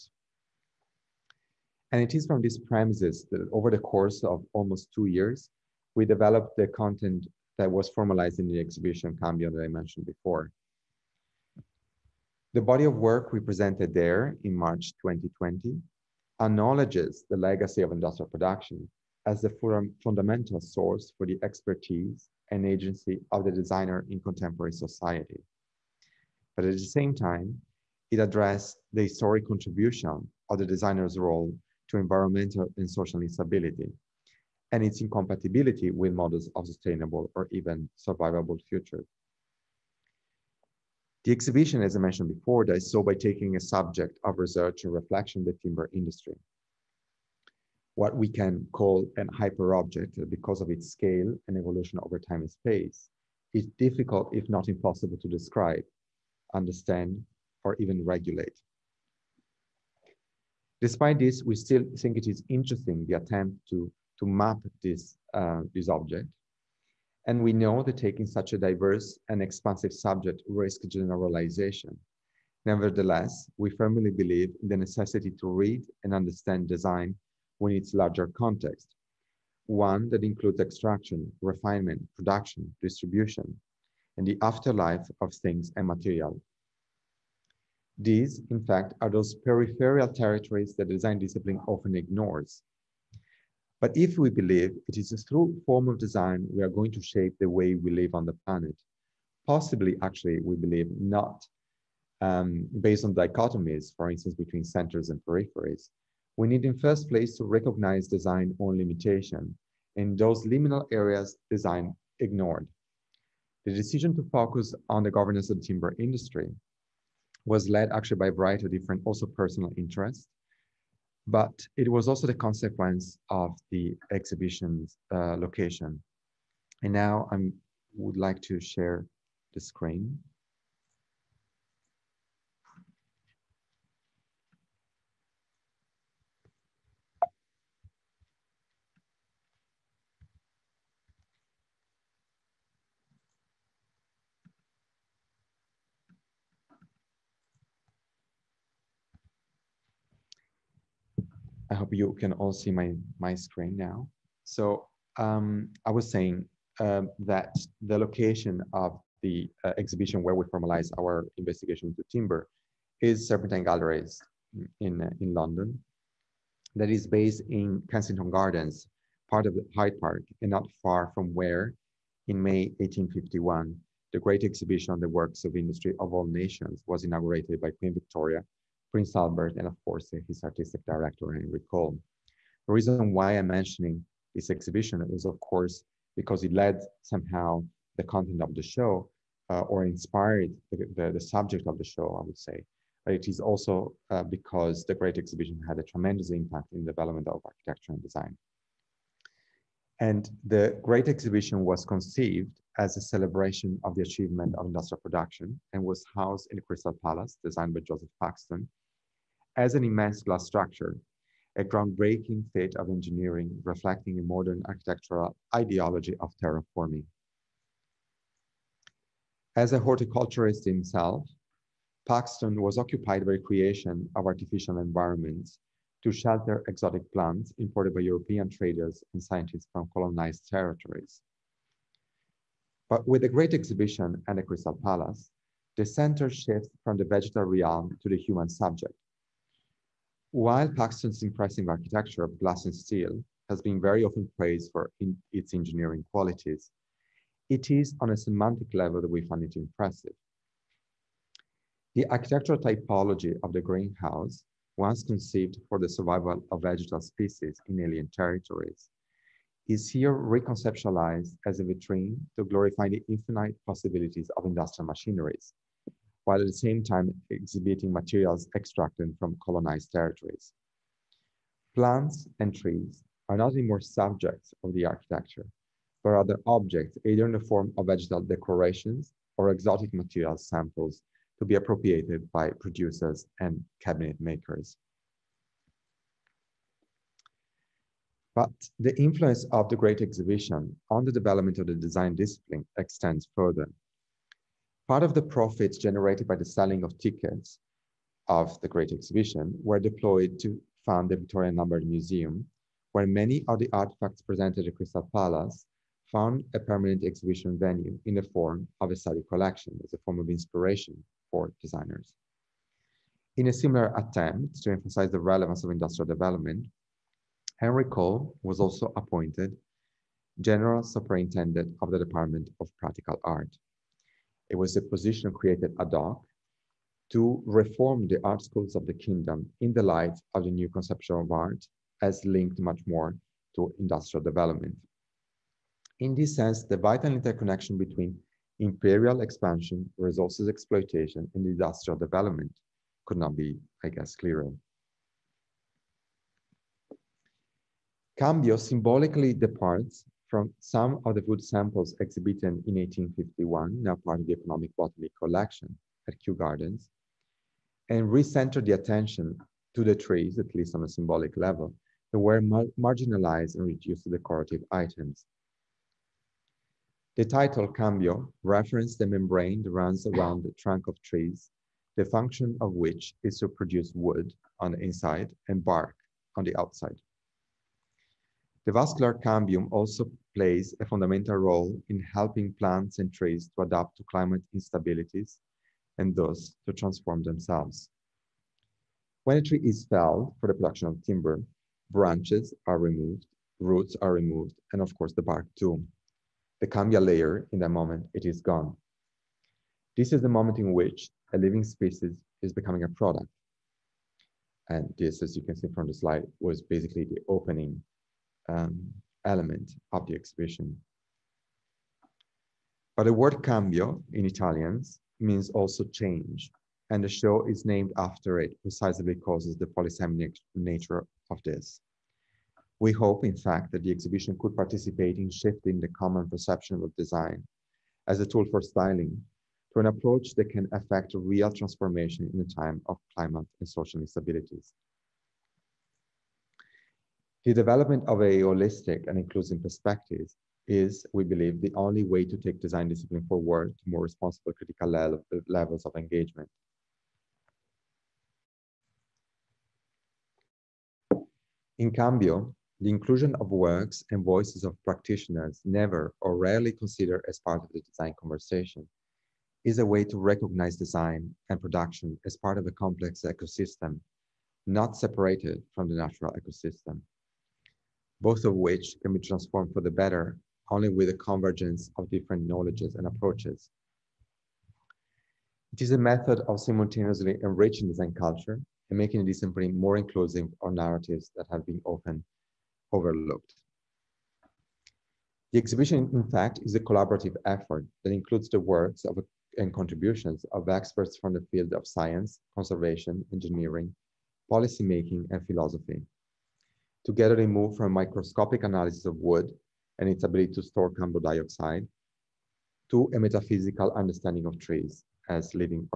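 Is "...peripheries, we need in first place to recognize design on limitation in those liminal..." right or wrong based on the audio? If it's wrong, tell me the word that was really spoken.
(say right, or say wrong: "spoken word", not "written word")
right.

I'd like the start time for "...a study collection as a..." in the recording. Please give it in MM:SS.
05:08.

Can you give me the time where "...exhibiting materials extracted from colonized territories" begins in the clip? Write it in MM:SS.
04:27.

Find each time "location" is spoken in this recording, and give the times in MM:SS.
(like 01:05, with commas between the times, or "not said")
02:05, 02:37.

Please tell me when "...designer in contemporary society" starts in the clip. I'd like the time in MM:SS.
00:23.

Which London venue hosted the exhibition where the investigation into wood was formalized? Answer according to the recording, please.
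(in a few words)
Serpentine Galleries.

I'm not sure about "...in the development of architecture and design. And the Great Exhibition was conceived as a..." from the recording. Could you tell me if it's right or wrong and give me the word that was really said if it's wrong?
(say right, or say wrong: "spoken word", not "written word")
right.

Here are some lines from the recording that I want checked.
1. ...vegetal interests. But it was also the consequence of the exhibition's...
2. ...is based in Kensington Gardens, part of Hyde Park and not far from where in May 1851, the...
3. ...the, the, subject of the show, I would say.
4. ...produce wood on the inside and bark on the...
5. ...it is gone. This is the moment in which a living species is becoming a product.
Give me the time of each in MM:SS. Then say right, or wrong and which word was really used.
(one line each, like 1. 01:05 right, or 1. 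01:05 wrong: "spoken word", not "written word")
1. 01:59 wrong: "personal", not "vegetal"
2. 02:46 right
3. 03:10 right
4. 06:13 right
5. 06:38 right.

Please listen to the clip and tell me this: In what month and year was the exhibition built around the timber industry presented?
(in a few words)
March 2020.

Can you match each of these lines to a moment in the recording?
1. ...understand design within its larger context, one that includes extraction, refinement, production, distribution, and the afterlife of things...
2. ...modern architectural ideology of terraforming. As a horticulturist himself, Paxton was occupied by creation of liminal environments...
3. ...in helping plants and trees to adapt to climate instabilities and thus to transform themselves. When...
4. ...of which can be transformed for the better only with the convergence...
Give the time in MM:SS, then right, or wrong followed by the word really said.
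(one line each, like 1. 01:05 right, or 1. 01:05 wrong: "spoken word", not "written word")
1. 01:16 right
2. 03:34 wrong: "artificial", not "liminal"
3. 06:21 right
4. 07:48 right.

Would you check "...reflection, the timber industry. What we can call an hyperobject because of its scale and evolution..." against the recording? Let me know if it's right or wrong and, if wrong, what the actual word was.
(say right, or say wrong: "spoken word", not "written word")
right.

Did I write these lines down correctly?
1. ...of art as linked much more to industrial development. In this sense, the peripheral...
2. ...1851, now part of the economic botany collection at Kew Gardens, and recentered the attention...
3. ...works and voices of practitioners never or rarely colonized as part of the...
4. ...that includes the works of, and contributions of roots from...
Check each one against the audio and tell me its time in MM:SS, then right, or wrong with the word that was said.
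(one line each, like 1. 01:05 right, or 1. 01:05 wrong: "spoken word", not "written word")
1. 05:31 wrong: "vital", not "peripheral"
2. 05:52 right
3. 07:33 wrong: "considered", not "colonized"
4. 08:08 wrong: "experts", not "roots".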